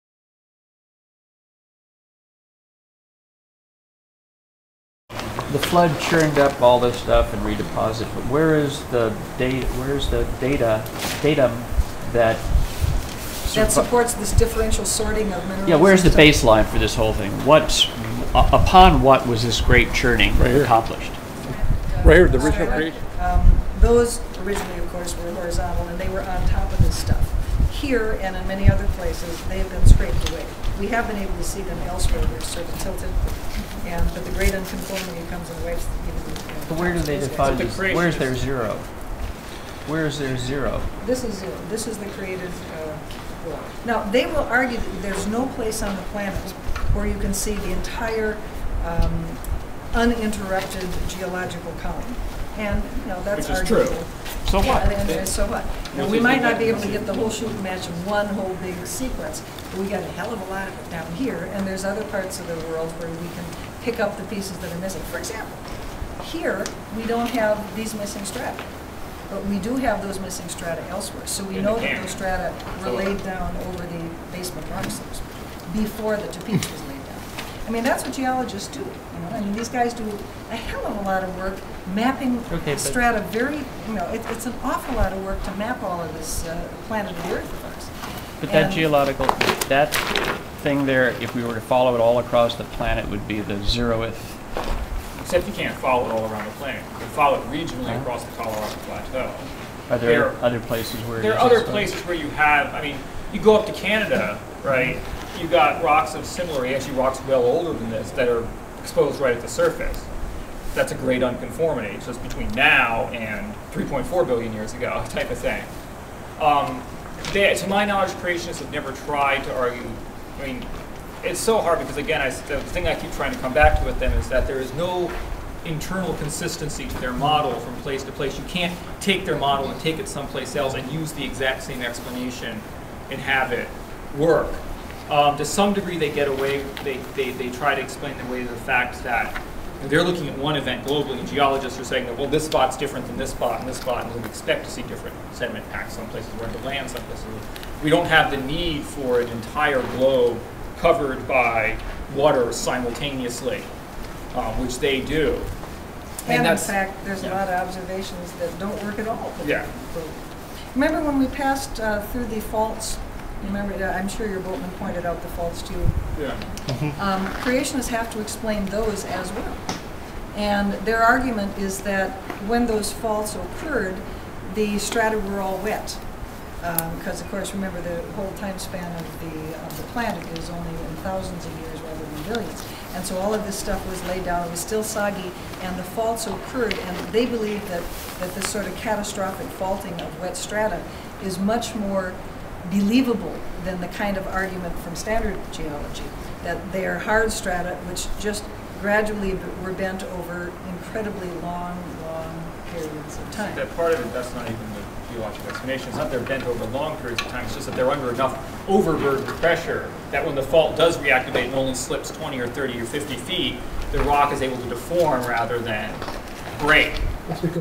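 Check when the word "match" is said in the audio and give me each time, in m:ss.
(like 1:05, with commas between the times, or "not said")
0:57.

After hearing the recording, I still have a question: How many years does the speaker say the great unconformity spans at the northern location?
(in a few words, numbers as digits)
3.4 billion years.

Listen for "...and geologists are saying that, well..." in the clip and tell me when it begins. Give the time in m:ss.
2:21.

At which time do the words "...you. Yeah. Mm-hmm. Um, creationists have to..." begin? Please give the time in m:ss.
2:45.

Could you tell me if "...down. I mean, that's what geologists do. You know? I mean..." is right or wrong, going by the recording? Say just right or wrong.
right.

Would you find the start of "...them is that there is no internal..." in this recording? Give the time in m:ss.
2:03.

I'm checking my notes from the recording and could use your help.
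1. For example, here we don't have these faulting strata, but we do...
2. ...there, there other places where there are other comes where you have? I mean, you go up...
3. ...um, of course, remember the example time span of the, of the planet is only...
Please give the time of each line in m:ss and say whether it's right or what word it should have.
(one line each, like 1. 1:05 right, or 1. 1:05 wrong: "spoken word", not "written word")
1. 1:05 wrong: "missing", not "faulting"
2. 1:39 wrong: "places", not "comes"
3. 2:57 wrong: "whole", not "example".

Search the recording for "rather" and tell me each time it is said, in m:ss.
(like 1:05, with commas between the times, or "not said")
3:01, 3:35.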